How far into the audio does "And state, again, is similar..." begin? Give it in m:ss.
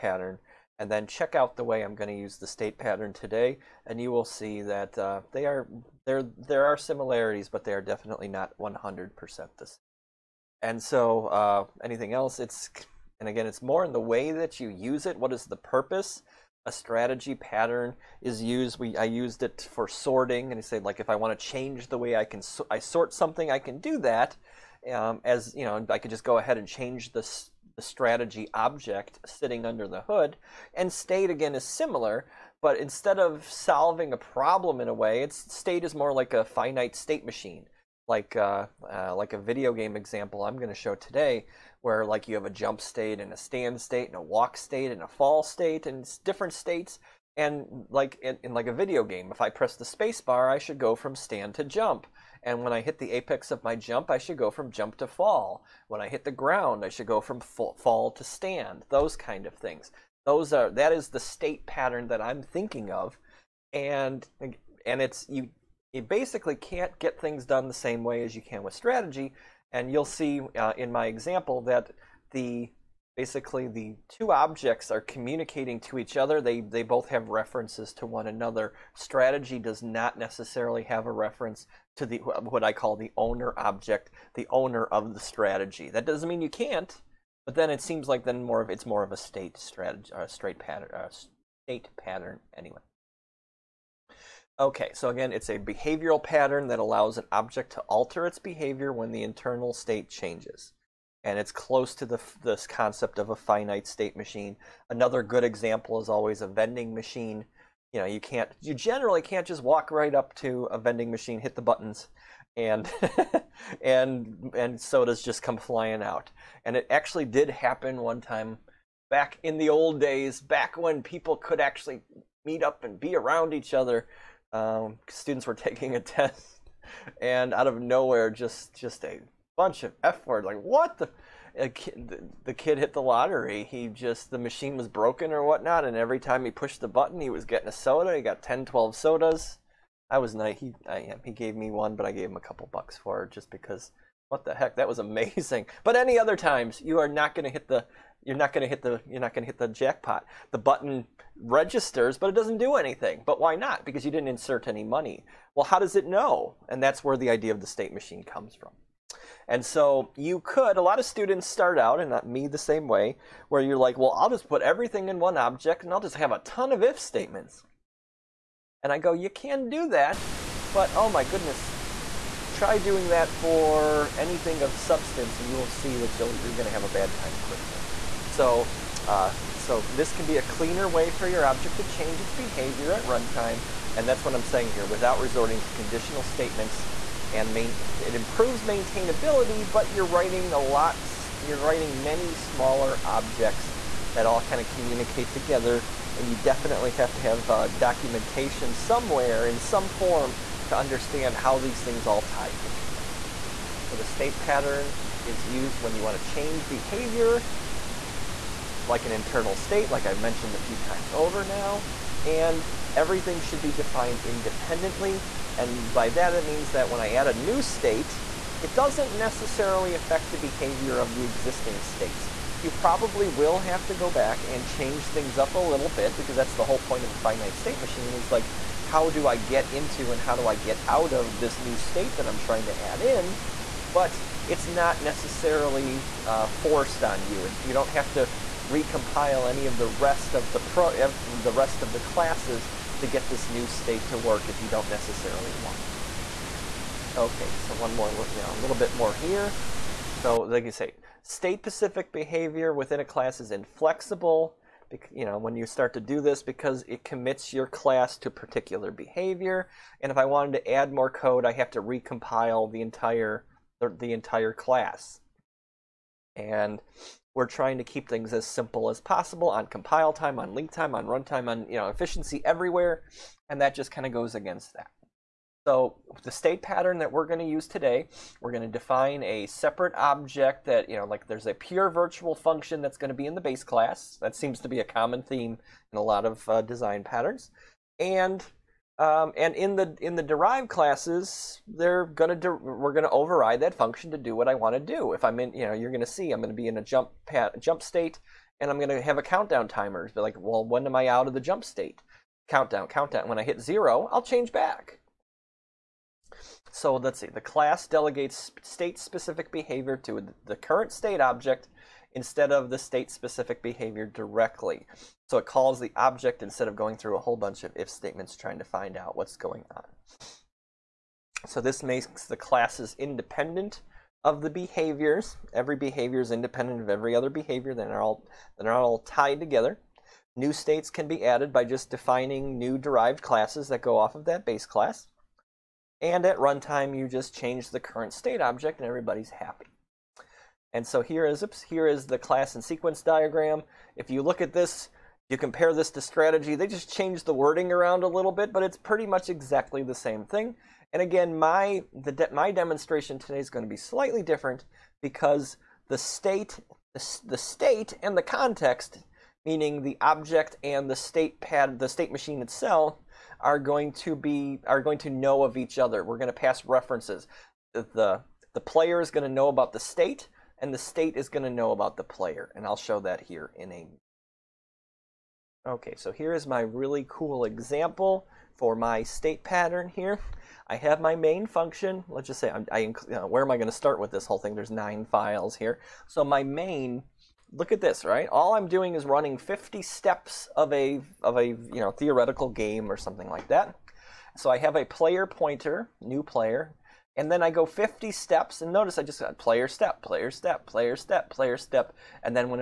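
0:30.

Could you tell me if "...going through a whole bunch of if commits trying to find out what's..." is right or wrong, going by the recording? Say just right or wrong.
wrong.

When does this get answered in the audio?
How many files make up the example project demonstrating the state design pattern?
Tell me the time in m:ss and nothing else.
6:24.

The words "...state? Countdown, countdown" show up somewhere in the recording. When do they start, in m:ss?
5:01.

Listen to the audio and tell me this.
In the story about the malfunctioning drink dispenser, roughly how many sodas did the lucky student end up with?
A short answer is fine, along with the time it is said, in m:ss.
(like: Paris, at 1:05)
10, 12, at 2:18.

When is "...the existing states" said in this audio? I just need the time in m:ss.
3:41.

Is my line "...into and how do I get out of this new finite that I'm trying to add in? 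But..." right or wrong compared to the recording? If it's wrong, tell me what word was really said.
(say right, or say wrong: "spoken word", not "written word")
wrong: "state", not "finite".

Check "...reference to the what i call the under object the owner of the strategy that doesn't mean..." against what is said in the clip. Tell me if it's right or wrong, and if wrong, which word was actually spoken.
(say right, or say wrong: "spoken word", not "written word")
wrong: "owner", not "under".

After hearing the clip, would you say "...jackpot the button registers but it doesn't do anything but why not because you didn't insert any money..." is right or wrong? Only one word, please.
right.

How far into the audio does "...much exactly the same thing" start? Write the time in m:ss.
5:49.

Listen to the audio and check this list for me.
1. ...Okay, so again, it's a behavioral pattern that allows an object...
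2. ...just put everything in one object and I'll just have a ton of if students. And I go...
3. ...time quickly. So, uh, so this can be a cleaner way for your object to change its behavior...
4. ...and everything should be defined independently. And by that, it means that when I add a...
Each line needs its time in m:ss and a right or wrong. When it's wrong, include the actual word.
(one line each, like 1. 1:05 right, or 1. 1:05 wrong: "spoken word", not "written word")
1. 1:34 right
2. 2:44 wrong: "statements", not "students"
3. 2:57 right
4. 3:32 right.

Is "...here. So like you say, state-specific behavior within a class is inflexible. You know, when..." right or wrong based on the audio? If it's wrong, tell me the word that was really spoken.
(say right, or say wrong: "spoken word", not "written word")
right.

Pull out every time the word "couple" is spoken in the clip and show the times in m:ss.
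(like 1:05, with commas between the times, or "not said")
2:22.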